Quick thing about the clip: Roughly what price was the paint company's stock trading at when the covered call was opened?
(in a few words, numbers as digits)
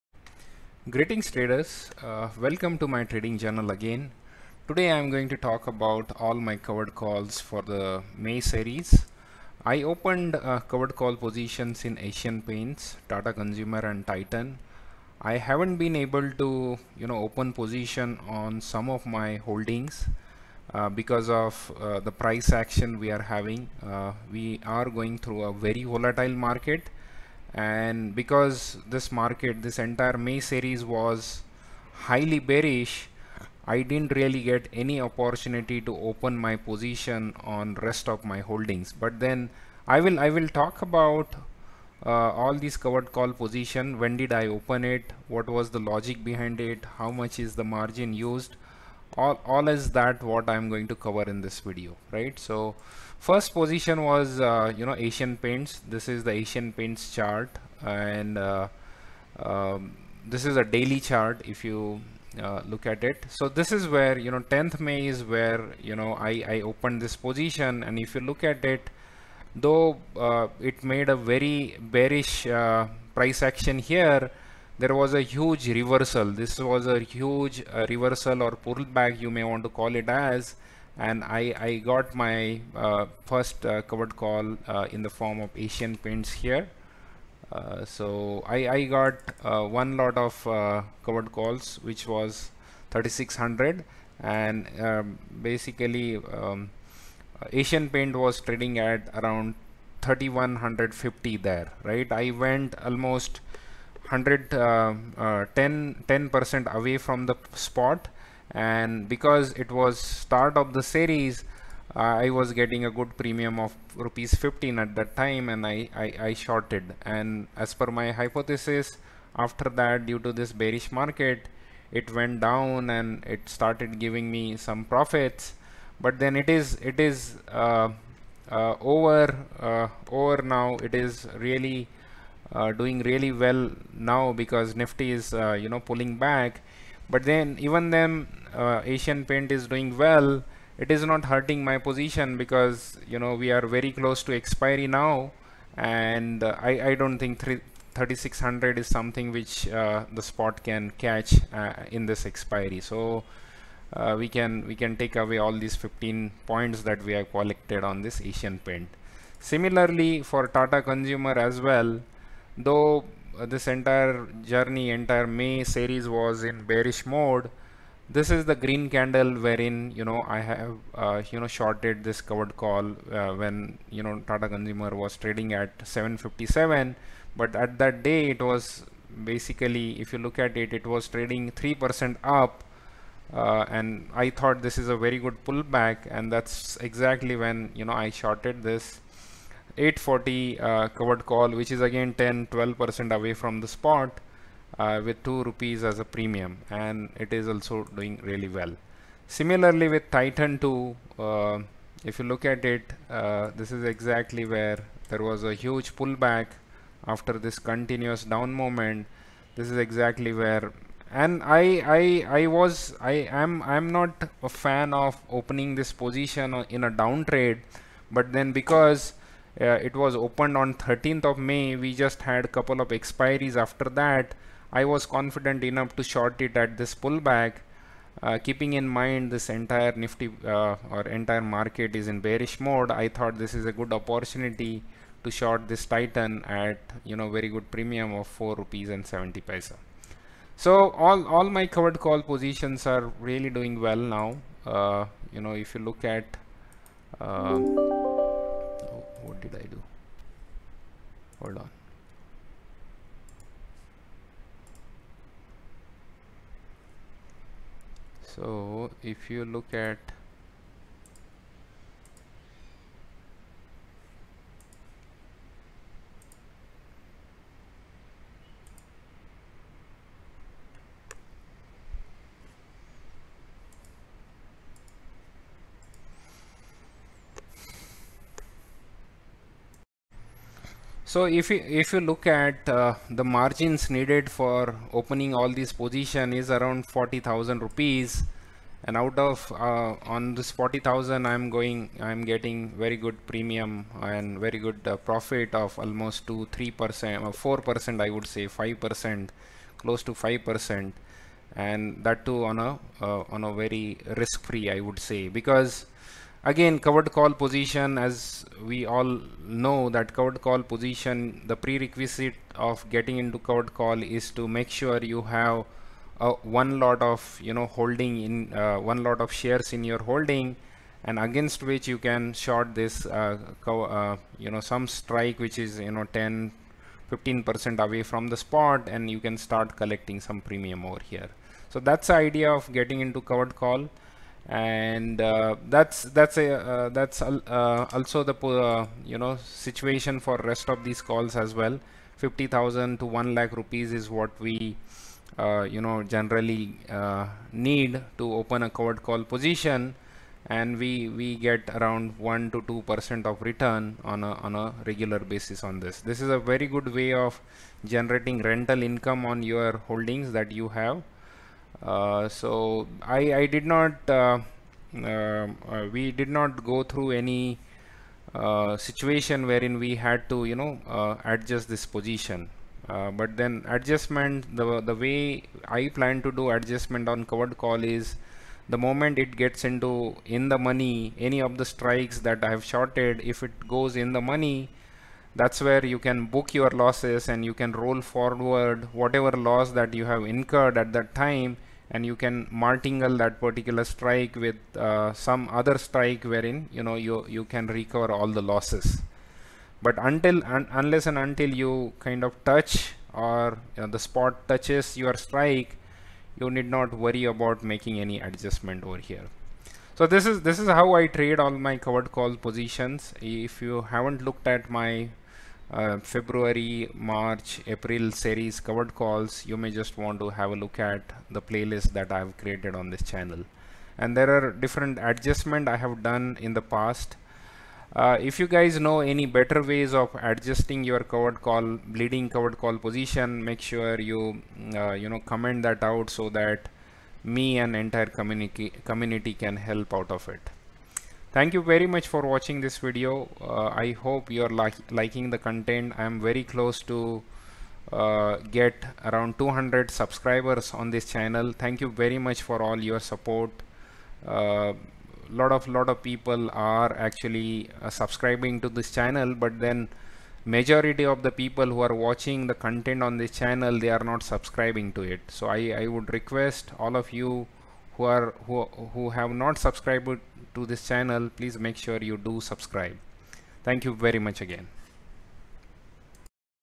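3150.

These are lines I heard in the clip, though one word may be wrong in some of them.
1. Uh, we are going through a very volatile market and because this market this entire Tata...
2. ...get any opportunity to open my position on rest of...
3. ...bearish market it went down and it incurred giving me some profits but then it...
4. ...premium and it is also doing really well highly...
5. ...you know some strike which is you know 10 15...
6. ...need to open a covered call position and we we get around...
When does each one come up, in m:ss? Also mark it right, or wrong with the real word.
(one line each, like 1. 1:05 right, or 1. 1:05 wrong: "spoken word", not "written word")
1. 0:23 wrong: "May", not "Tata"
2. 0:34 right
3. 2:00 wrong: "started", not "incurred"
4. 3:16 wrong: "similarly", not "highly"
5. 5:24 right
6. 5:47 right.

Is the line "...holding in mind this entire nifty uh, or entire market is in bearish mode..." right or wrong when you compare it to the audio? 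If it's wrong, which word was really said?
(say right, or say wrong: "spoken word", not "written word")
wrong: "keeping", not "holding".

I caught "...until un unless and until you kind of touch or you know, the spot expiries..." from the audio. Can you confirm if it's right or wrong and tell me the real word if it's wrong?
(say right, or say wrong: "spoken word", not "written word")
wrong: "touches", not "expiries".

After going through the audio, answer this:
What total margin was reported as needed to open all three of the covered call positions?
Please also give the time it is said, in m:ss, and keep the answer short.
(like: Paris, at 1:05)
40,000 rupees, at 4:46.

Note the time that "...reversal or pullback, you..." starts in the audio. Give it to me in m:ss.
1:17.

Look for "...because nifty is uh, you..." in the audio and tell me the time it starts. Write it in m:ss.
2:14.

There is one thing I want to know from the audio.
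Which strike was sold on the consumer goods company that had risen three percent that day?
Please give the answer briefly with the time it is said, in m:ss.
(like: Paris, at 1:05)
840, at 3:09.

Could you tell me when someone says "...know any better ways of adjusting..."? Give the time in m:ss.
7:08.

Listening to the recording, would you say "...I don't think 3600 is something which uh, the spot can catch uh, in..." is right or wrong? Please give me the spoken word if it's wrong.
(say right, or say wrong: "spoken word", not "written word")
right.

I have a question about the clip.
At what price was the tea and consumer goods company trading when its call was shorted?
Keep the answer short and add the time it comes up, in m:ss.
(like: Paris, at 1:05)
757, at 2:55.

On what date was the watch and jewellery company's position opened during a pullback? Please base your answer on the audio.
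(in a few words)
13th of May.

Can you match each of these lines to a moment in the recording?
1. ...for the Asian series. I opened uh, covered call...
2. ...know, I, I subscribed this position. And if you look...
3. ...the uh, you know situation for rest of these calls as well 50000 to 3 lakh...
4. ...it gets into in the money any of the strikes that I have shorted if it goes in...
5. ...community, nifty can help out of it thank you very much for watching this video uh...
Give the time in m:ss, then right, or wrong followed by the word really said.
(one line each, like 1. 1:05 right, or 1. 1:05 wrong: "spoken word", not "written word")
1. 0:07 wrong: "May", not "Asian"
2. 1:05 wrong: "opened", not "subscribed"
3. 5:38 wrong: "1", not "3"
4. 6:19 right
5. 7:18 wrong: "community", not "nifty".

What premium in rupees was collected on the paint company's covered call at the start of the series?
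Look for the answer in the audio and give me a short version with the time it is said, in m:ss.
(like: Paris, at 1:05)
15, at 1:53.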